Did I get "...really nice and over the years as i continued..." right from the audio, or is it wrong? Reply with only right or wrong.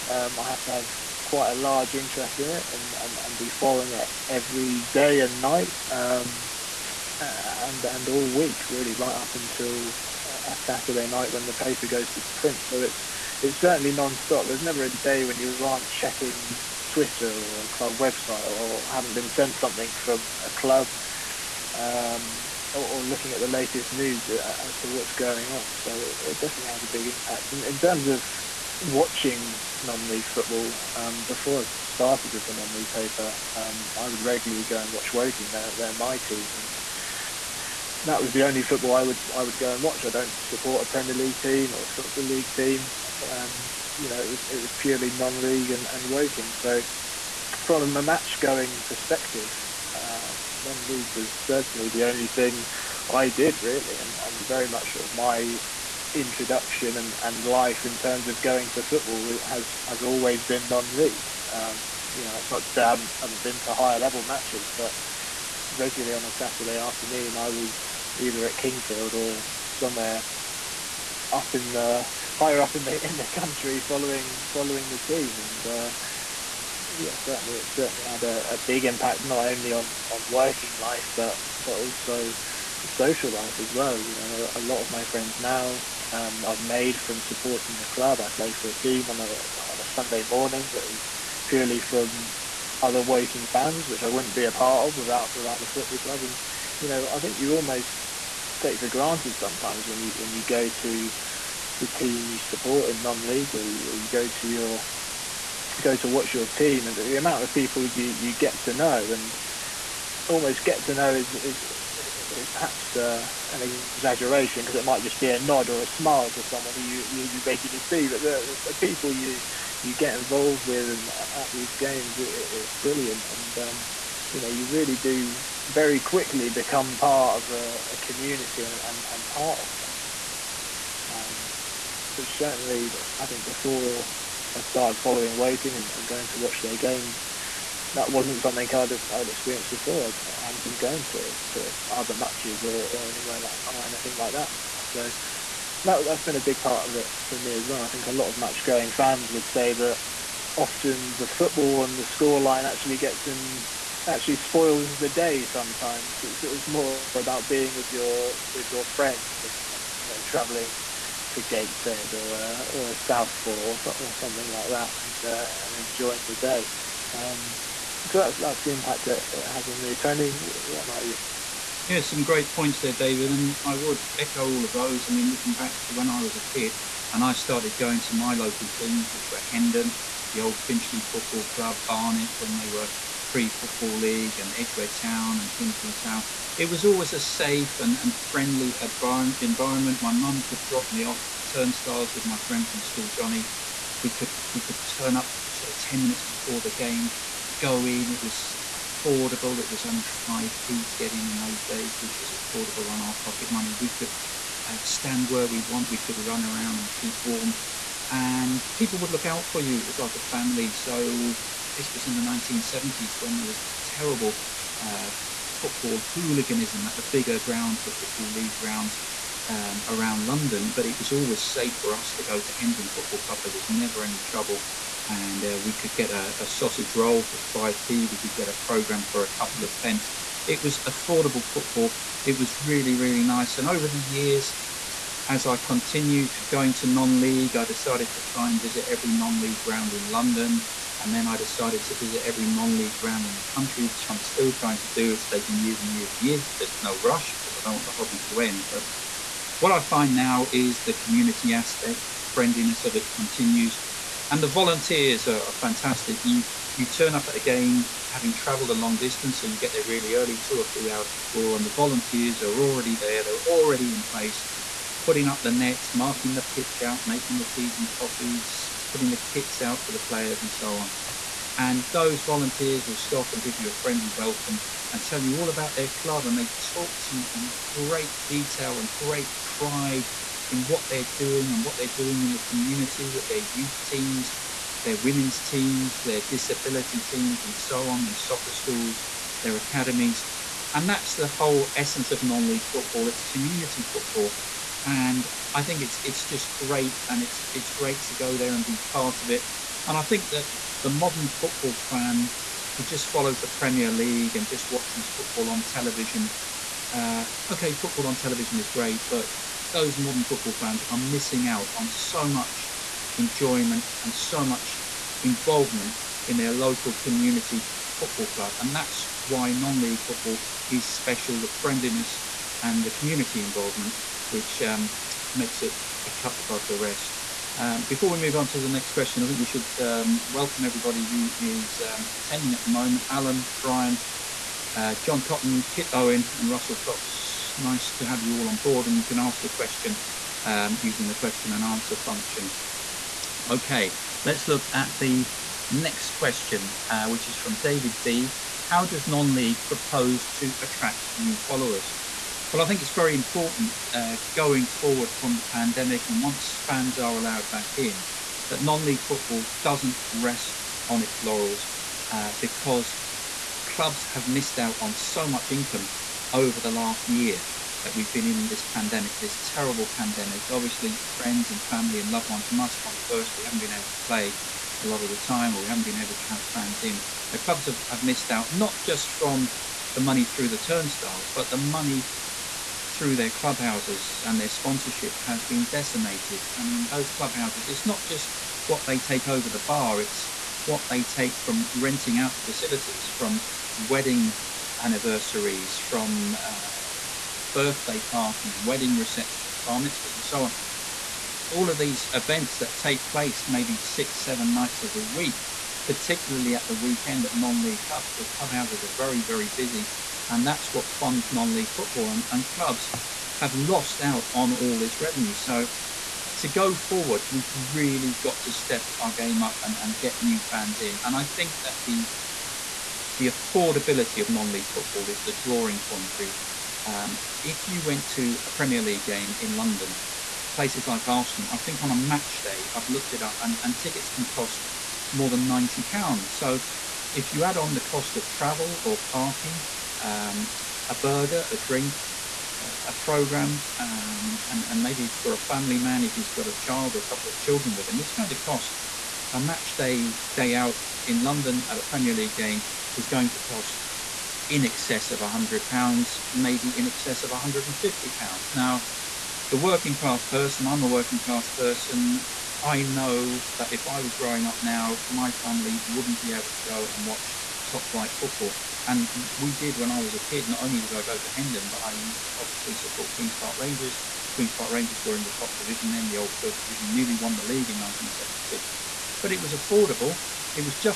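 right.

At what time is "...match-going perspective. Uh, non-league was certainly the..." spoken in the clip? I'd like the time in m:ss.
0:48.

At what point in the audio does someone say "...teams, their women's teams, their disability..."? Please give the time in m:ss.
4:43.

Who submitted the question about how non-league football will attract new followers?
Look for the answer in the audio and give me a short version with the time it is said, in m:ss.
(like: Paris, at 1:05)
David B, at 5:47.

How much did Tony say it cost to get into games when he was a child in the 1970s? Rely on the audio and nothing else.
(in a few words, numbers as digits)
5p.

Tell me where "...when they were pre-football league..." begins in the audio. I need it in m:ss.
3:02.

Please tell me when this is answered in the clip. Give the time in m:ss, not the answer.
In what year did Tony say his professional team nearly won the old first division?
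7:57.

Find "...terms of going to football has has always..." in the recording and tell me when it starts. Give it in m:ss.
0:57.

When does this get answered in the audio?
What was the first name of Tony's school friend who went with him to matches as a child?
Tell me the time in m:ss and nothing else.
3:13.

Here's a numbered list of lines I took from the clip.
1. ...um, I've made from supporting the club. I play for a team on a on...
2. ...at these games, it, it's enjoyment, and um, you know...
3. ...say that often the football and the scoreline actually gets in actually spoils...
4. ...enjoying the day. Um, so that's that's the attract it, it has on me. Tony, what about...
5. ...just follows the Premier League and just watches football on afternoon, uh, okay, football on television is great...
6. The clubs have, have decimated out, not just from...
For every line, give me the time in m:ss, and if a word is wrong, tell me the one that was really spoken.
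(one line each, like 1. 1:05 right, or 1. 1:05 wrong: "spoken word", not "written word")
1. 1:26 right
2. 2:01 wrong: "brilliant", not "enjoyment"
3. 2:29 right
4. 2:45 wrong: "impact", not "attract"
5. 5:02 wrong: "television", not "afternoon"
6. 6:17 wrong: "missed", not "decimated".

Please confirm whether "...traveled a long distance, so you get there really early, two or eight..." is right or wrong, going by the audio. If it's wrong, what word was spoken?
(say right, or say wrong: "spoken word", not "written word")
wrong: "three", not "eight".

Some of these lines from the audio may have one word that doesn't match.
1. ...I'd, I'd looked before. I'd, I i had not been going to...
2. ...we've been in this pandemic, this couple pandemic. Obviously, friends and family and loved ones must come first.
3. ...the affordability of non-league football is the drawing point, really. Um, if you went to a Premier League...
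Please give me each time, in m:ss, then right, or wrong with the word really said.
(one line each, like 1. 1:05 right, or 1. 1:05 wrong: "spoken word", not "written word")
1. 2:18 wrong: "experienced", not "looked"
2. 6:07 wrong: "terrible", not "couple"
3. 7:03 right.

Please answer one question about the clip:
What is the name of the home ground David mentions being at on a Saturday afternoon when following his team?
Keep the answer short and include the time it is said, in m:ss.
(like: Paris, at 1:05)
Kingfield, at 1:08.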